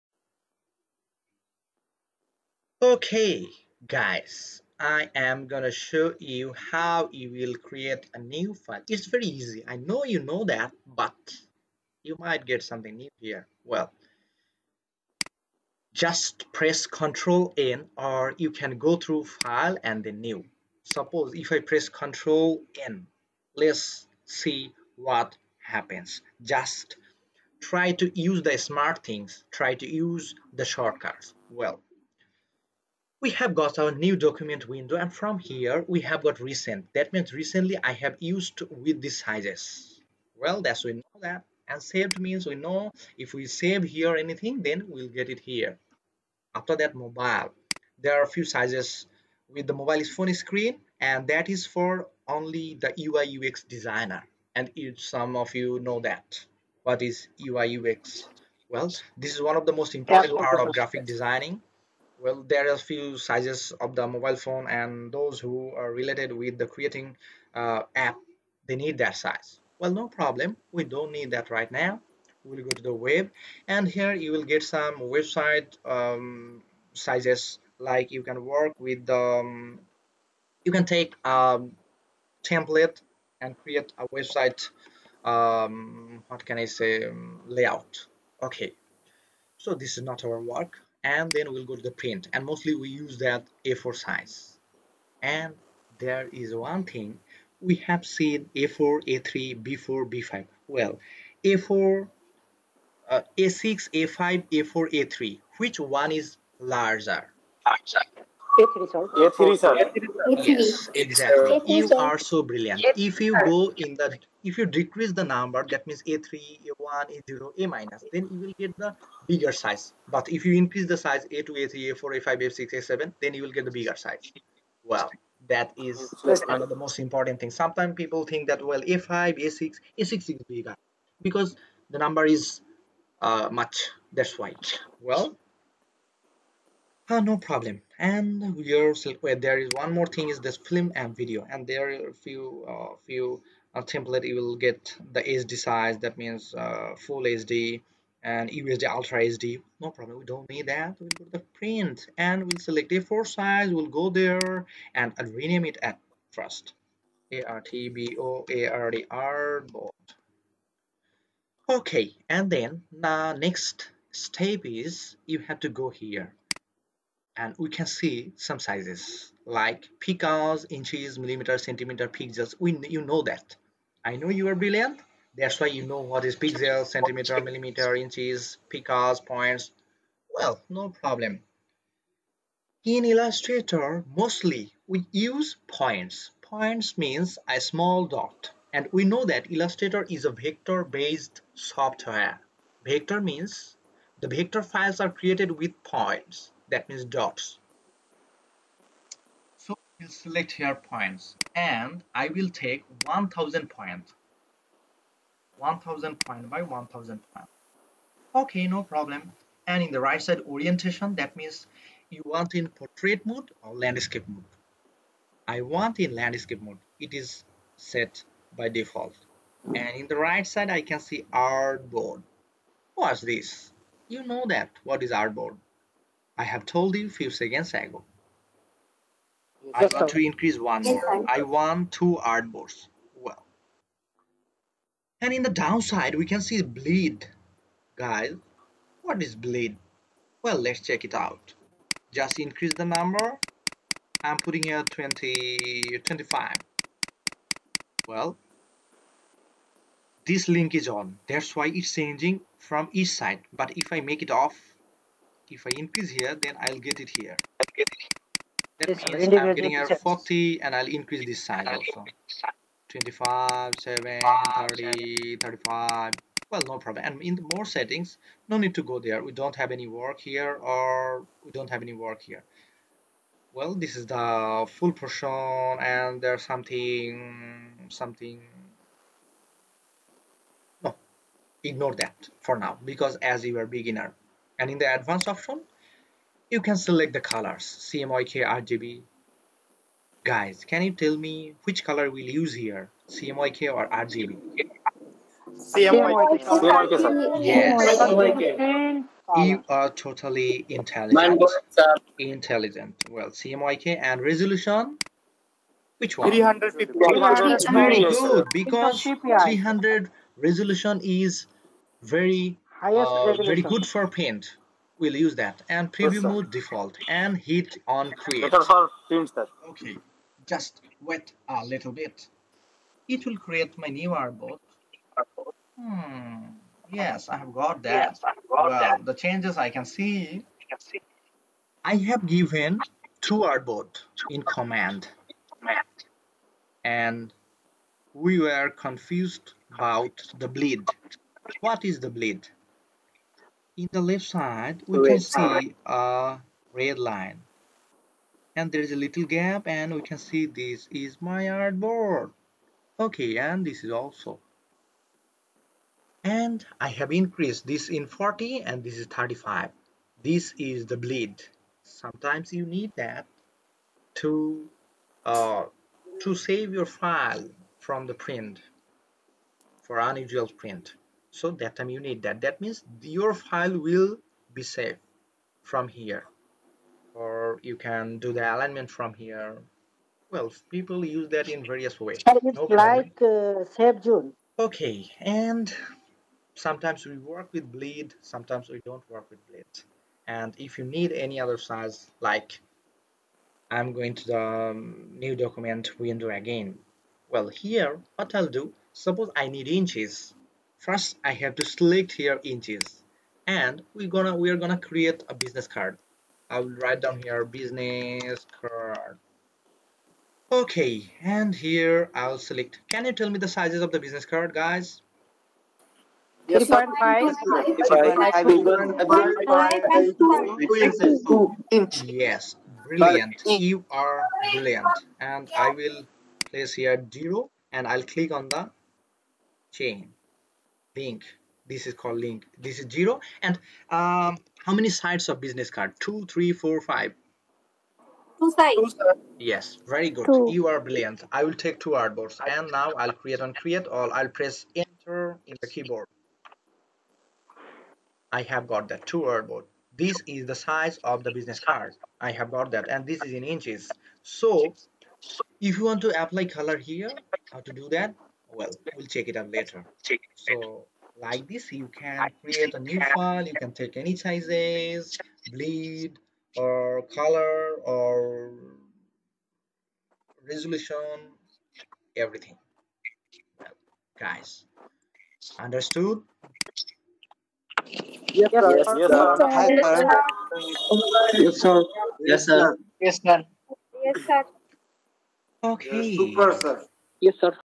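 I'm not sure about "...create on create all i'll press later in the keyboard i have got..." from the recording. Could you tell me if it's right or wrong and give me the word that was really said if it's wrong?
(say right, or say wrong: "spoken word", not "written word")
wrong: "enter", not "later".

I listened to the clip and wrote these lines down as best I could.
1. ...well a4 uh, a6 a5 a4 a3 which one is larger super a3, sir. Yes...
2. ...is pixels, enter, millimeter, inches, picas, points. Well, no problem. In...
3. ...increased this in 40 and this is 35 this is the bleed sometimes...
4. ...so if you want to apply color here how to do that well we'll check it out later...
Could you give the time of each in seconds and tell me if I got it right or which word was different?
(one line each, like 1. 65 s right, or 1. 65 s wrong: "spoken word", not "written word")
1. 100 s wrong: "larger", not "super"
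2. 176 s wrong: "centimeter", not "enter"
3. 357 s right
4. 454 s right.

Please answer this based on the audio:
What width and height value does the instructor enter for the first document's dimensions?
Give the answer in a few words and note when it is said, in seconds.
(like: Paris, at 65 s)
1000 points, at 203 s.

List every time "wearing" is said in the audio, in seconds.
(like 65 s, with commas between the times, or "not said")
not said.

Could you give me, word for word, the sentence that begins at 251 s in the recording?
That's why it's changing from each side.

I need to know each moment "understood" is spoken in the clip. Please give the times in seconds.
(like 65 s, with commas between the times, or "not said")
475 s.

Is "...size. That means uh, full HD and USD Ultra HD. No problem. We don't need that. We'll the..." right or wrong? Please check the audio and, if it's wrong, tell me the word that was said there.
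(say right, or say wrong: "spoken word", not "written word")
right.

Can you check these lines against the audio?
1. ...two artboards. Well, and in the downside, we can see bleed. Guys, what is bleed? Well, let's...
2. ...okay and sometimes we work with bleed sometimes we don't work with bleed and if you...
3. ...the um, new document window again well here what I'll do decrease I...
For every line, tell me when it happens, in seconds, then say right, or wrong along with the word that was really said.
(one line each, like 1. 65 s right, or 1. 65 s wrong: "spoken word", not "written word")
1. 231 s right
2. 384 s right
3. 394 s wrong: "suppose", not "decrease".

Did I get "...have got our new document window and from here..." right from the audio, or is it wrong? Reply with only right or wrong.
right.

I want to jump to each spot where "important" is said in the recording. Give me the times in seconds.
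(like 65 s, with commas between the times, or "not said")
59 s, 126 s.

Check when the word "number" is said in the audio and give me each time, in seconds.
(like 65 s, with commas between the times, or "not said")
115 s, 131 s, 242 s.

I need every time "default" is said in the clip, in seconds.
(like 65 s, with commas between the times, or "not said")
218 s, 316 s.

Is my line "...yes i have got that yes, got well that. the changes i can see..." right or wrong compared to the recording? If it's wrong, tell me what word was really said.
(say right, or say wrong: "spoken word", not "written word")
right.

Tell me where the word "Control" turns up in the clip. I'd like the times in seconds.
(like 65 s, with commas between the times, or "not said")
16 s, 21 s.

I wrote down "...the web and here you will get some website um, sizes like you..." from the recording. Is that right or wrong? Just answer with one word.
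right.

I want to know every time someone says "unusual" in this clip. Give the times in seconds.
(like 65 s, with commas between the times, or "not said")
369 s.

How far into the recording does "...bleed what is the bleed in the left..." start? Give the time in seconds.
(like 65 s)
340 s.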